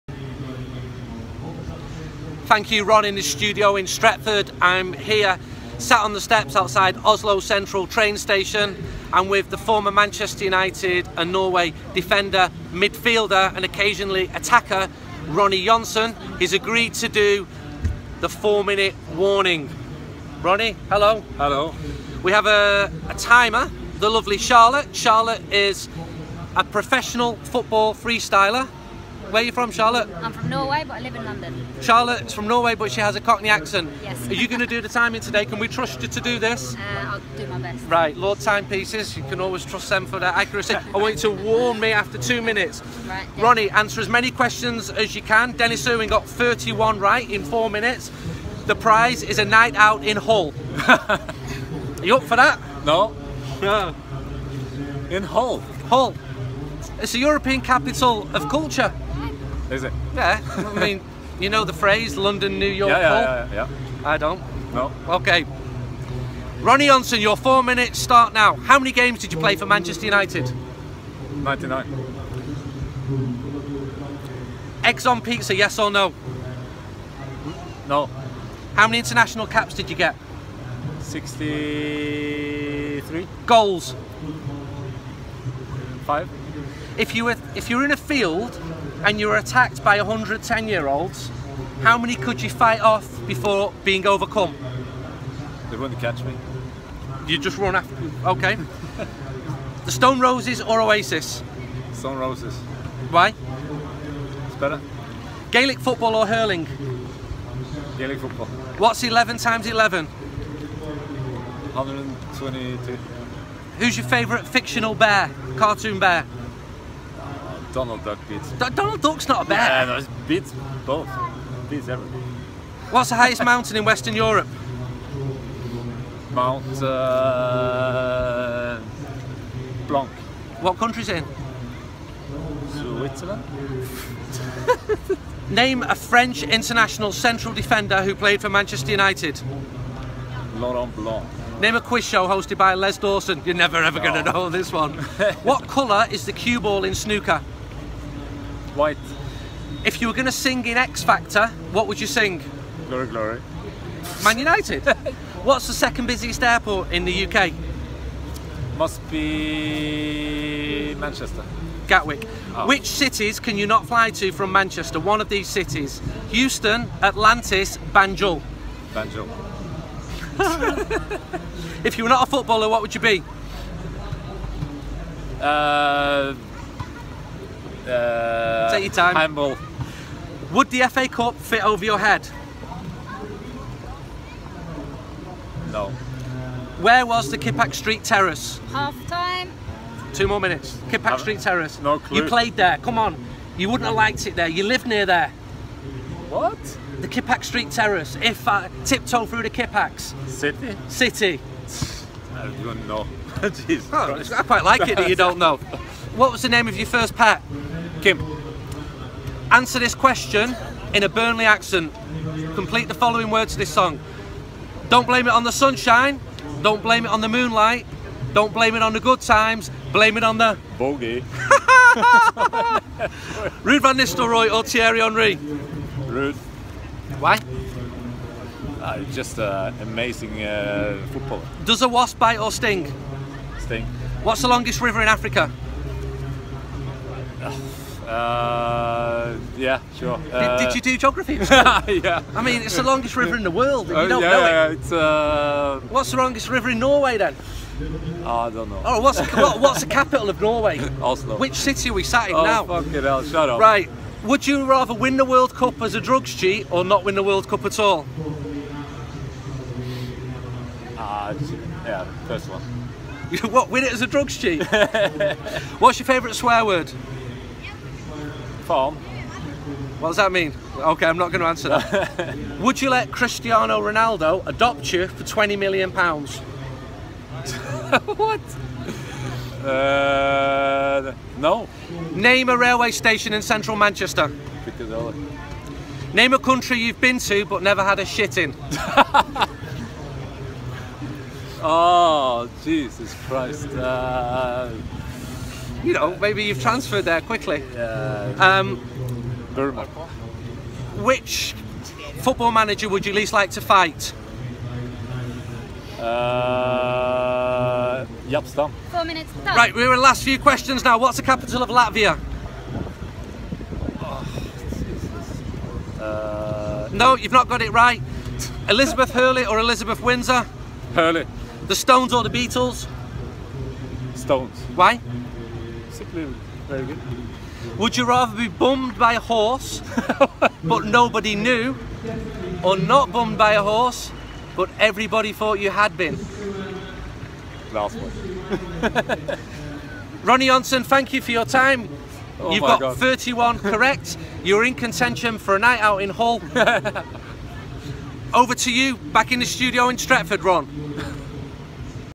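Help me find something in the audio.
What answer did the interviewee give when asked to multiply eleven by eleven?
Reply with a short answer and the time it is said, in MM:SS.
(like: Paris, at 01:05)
122, at 01:50.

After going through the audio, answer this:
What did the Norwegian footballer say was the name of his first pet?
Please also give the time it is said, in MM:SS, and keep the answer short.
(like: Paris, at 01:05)
Kim, at 03:28.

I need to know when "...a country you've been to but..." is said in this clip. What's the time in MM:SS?
04:46.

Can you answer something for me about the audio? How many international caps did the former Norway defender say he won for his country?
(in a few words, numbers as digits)
63.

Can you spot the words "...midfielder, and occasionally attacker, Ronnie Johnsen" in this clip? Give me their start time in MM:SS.
00:12.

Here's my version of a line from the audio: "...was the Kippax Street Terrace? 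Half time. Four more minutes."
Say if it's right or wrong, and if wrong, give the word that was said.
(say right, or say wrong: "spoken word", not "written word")
wrong: "Two", not "Four".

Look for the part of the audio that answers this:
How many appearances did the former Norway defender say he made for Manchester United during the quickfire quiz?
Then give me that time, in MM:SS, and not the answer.
01:11.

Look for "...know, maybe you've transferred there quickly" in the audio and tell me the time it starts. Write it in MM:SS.
04:55.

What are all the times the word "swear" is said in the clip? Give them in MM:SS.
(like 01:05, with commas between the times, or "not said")
04:26.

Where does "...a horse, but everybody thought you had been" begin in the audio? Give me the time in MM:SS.
05:33.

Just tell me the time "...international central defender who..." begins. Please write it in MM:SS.
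02:16.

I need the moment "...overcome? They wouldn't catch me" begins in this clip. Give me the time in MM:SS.
01:34.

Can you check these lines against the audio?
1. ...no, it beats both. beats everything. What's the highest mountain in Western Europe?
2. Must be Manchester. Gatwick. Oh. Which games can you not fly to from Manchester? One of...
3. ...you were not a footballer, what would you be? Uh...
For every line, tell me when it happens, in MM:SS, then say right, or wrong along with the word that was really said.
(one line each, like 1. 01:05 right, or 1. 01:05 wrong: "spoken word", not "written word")
1. 01:59 right
2. 02:38 wrong: "cities", not "games"
3. 02:51 right.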